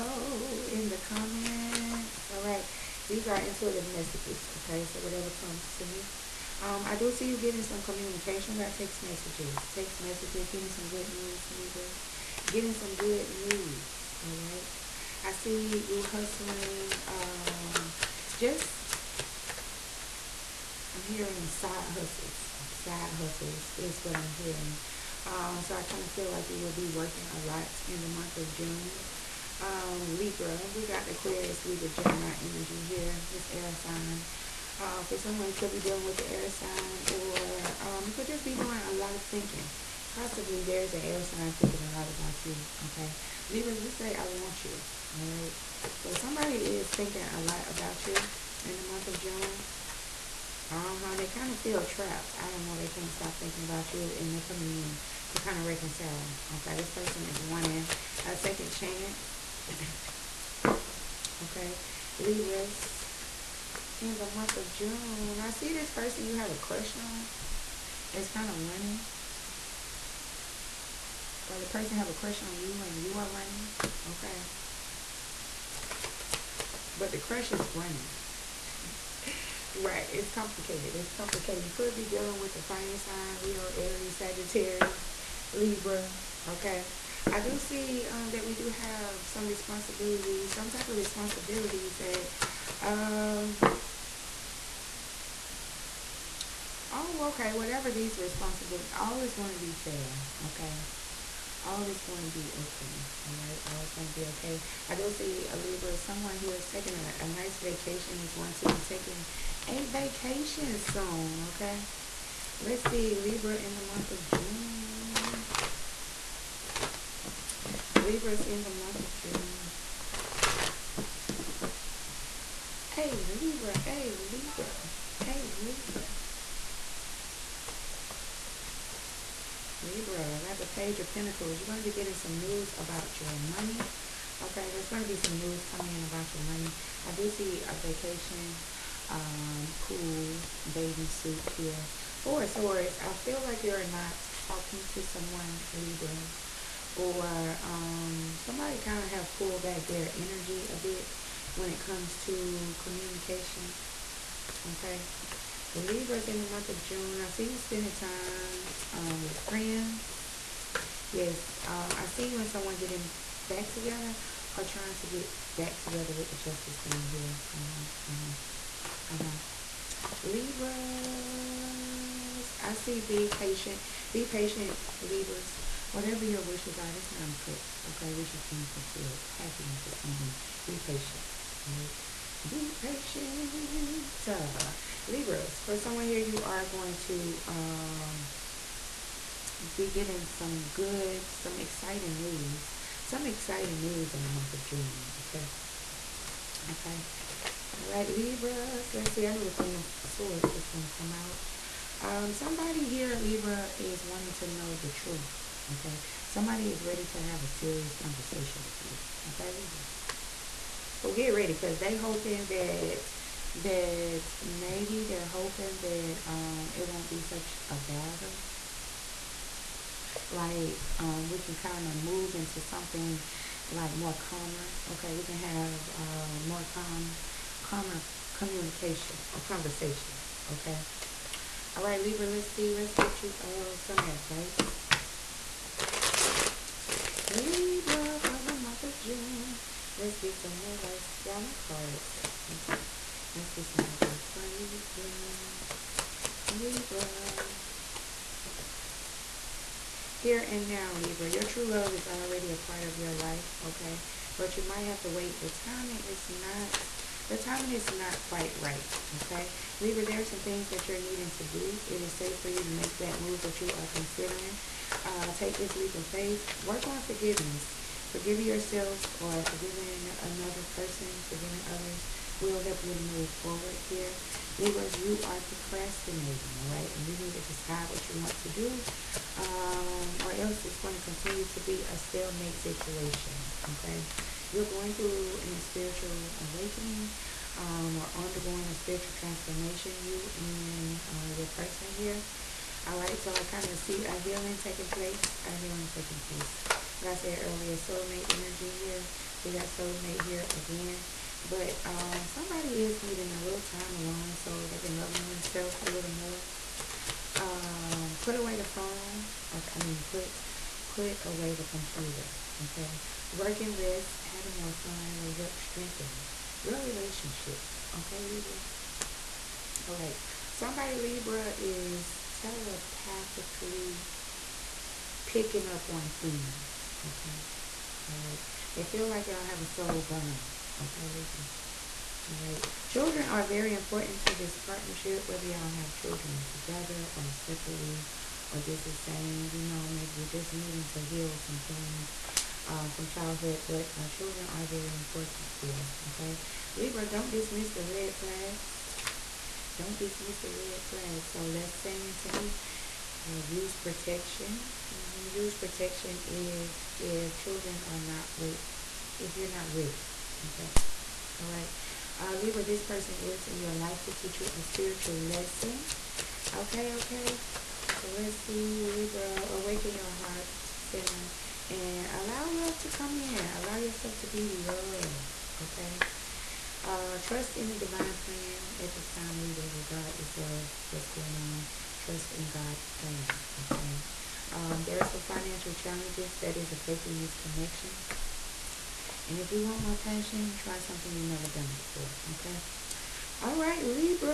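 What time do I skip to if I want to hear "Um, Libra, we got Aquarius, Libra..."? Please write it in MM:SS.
00:29.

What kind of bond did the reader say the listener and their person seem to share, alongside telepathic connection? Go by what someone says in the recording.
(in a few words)
Soul bond.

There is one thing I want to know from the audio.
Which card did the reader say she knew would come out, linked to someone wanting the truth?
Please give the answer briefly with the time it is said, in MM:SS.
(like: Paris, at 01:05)
Queen of Swords, at 03:19.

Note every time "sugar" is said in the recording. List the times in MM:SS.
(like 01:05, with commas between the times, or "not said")
not said.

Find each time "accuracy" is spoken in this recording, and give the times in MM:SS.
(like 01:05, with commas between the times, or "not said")
not said.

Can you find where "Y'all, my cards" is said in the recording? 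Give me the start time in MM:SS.
04:01.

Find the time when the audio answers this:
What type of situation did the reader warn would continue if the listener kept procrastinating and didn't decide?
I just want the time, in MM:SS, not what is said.
04:41.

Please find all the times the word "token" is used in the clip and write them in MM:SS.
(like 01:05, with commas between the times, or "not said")
not said.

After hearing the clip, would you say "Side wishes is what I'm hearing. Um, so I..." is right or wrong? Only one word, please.
wrong.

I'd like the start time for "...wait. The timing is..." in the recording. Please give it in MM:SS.
04:15.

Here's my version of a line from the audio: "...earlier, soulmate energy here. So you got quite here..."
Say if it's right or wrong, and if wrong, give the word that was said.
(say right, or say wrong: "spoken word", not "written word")
wrong: "soulmate", not "quite".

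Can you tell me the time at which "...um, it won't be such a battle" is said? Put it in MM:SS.
03:36.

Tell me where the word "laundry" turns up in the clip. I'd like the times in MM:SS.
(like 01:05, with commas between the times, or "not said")
not said.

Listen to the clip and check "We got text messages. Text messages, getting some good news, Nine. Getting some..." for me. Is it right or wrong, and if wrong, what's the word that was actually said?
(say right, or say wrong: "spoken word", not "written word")
wrong: "Libras", not "Nine".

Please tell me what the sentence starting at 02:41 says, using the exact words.
Yes, um, I see you and someone getting back together or trying to get back together with the justice being here.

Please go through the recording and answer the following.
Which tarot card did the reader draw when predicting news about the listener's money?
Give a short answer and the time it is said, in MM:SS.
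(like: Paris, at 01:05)
Page of Pentacles, at 02:10.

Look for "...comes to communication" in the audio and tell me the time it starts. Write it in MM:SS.
02:31.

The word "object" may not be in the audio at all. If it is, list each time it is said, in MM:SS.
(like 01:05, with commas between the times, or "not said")
not said.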